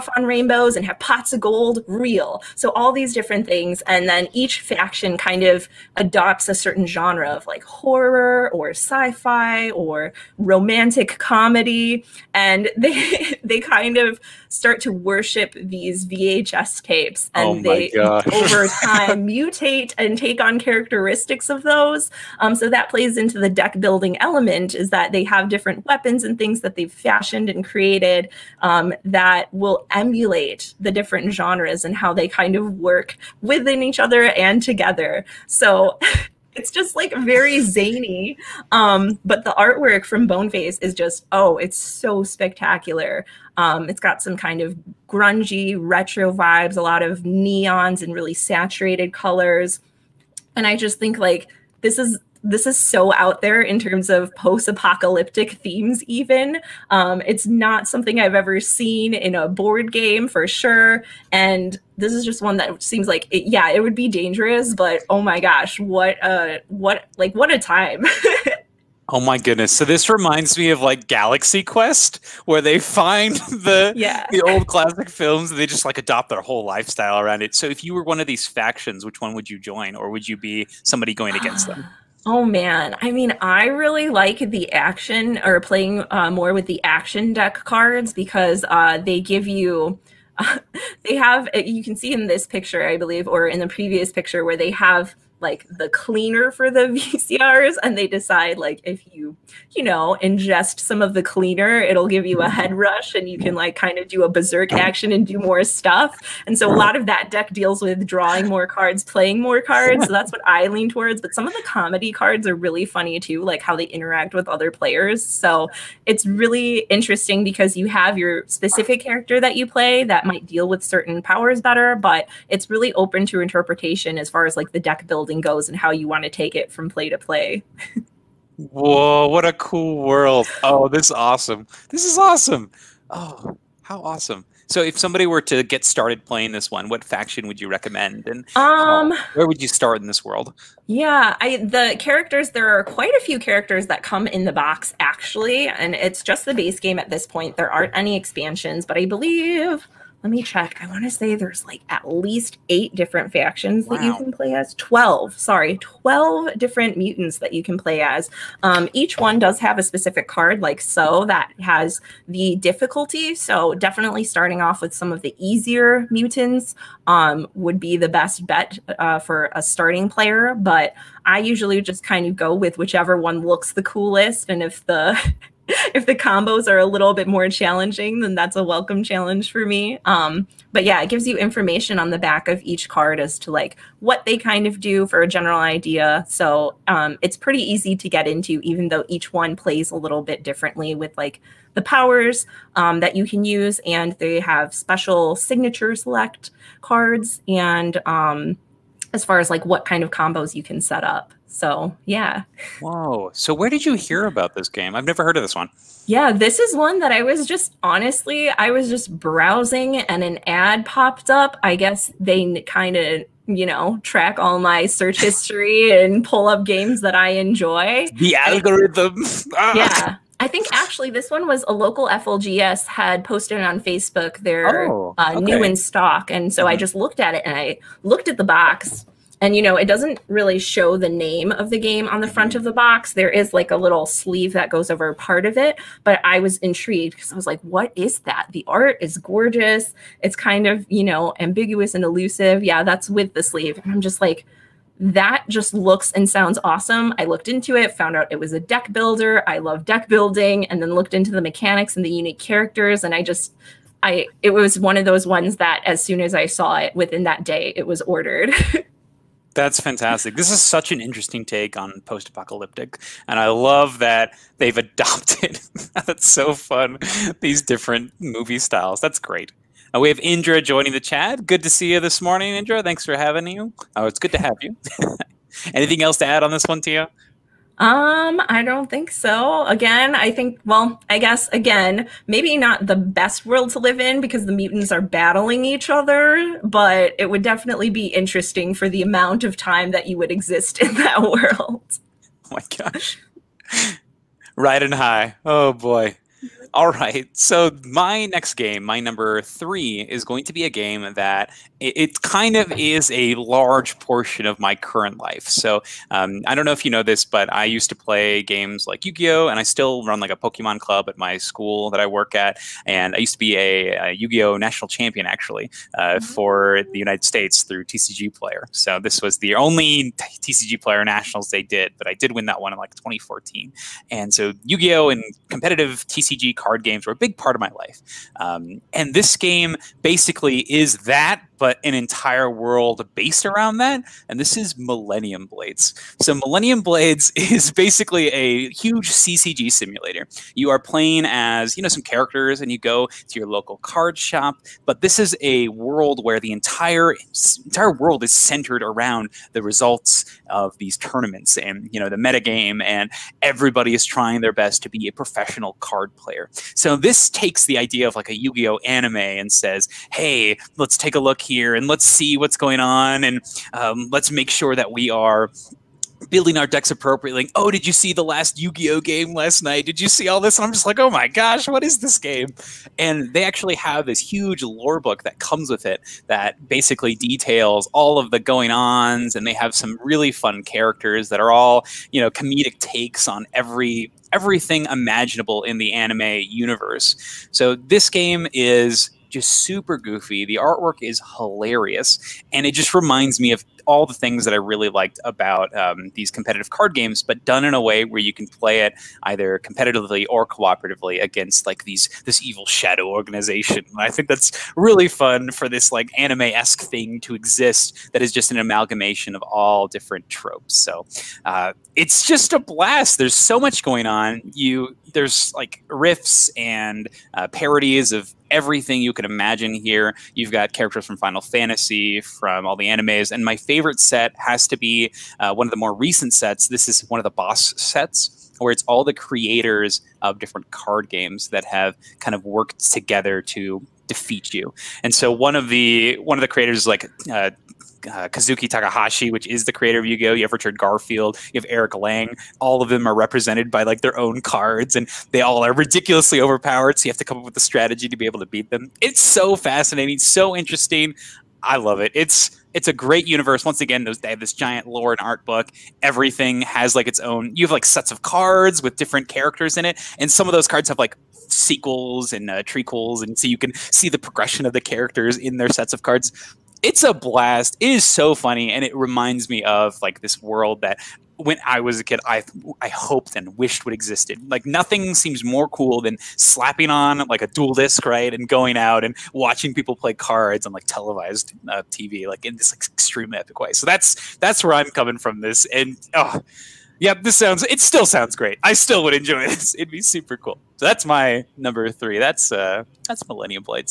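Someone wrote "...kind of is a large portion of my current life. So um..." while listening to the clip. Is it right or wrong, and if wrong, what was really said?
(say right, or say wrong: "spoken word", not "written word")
right.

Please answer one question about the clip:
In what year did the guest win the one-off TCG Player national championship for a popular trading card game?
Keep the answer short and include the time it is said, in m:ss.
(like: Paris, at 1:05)
2014, at 5:22.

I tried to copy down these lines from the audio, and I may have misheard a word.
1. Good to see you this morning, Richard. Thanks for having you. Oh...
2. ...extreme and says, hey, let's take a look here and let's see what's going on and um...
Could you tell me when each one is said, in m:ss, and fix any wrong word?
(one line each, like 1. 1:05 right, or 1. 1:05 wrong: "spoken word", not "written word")
1. 4:31 wrong: "Indra", not "Richard"
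2. 5:58 wrong: "anime", not "extreme".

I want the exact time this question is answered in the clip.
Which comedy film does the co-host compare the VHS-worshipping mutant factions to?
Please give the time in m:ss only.
1:11.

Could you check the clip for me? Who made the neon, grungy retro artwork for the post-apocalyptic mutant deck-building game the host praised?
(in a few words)
Boneface.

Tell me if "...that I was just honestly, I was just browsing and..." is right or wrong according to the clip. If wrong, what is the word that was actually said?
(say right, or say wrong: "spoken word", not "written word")
right.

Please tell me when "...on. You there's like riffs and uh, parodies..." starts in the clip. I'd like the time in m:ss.
6:54.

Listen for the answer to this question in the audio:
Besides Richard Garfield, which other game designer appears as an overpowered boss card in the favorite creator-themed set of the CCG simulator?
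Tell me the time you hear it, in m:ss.
7:21.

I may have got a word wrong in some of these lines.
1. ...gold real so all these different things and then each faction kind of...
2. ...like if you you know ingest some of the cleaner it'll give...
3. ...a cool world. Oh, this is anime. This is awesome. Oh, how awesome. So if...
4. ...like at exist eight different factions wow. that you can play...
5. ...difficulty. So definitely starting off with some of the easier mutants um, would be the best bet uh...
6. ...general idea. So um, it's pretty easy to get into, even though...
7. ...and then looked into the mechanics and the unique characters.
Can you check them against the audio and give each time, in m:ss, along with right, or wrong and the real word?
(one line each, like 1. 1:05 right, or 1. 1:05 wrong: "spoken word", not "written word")
1. 0:01 right
2. 1:38 right
3. 2:09 wrong: "awesome", not "anime"
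4. 2:31 wrong: "least", not "exist"
5. 2:42 right
6. 3:05 right
7. 4:10 right.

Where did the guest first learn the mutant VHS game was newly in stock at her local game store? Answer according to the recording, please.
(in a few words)
Facebook.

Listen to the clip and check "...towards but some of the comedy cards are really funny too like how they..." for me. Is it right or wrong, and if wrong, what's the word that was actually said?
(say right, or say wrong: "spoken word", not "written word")
right.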